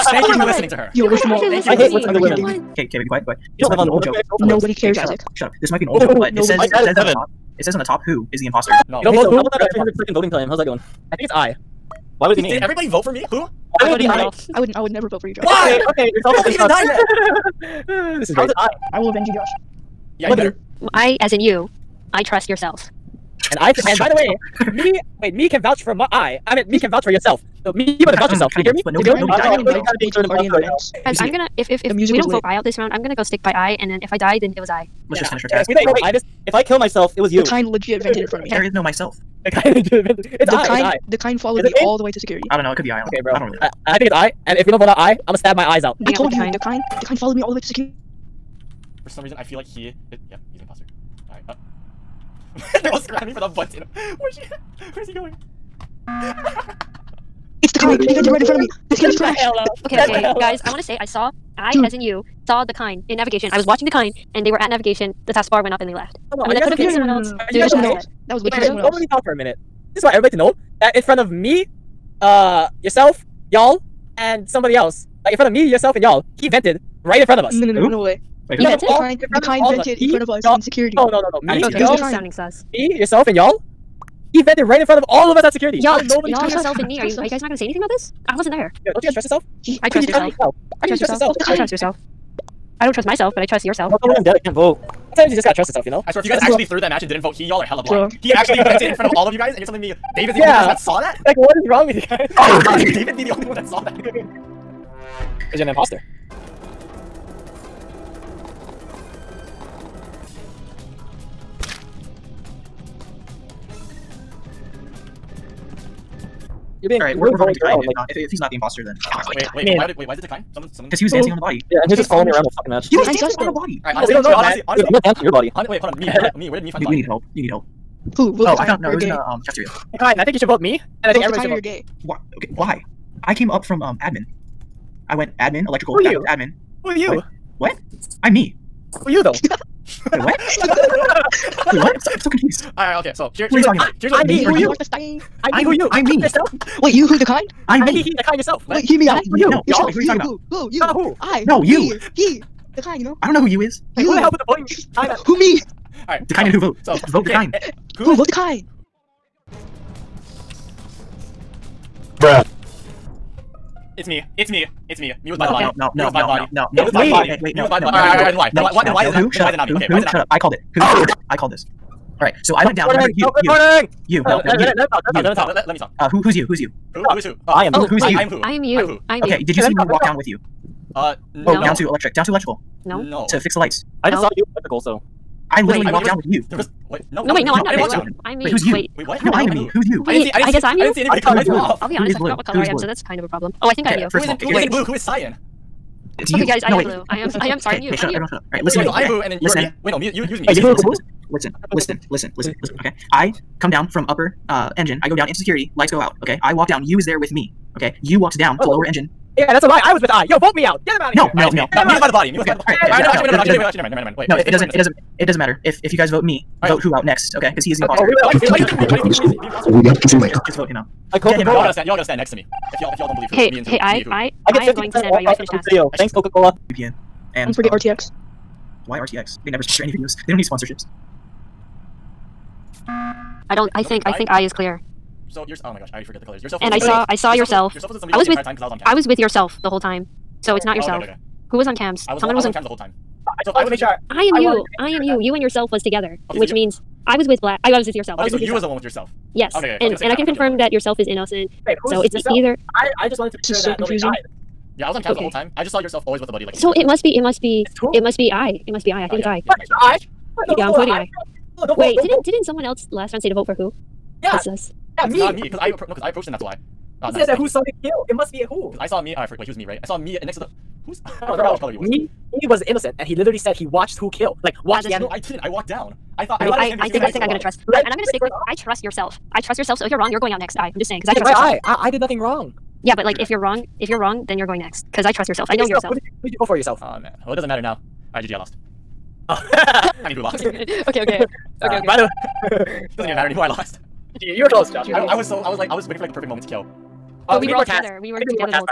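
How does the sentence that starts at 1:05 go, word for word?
The taskbar went up, and they left.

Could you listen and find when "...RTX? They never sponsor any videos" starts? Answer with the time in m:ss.
3:48.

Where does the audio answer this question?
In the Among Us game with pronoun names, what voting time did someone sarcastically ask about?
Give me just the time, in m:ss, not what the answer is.
0:09.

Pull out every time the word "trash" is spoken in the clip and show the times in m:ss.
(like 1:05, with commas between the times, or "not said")
0:59.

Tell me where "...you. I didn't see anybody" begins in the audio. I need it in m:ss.
3:10.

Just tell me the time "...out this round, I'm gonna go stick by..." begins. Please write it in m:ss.
0:32.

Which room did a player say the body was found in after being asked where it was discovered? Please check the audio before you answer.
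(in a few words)
cafeteria.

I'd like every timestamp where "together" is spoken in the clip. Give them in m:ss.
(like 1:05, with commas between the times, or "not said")
4:05, 4:57.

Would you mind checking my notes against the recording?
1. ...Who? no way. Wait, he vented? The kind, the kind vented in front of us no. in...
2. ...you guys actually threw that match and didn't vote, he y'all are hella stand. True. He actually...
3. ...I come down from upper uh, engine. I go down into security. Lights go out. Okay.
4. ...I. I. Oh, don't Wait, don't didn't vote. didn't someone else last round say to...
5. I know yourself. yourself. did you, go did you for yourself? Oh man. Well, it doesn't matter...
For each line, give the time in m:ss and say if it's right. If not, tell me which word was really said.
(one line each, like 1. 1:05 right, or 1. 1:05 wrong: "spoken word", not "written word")
1. 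1:17 right
2. 1:36 wrong: "blind", not "stand"
3. 3:23 right
4. 4:20 right
5. 4:45 right.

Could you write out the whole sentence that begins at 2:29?
Wait, who are you, you talking about?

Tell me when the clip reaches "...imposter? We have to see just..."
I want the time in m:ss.
3:39.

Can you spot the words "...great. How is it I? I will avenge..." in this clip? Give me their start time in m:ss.
0:18.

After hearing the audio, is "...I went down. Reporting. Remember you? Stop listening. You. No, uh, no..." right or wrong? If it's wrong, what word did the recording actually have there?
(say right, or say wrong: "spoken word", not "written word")
wrong: "reporting", not "listening".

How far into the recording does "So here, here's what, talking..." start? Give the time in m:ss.
2:23.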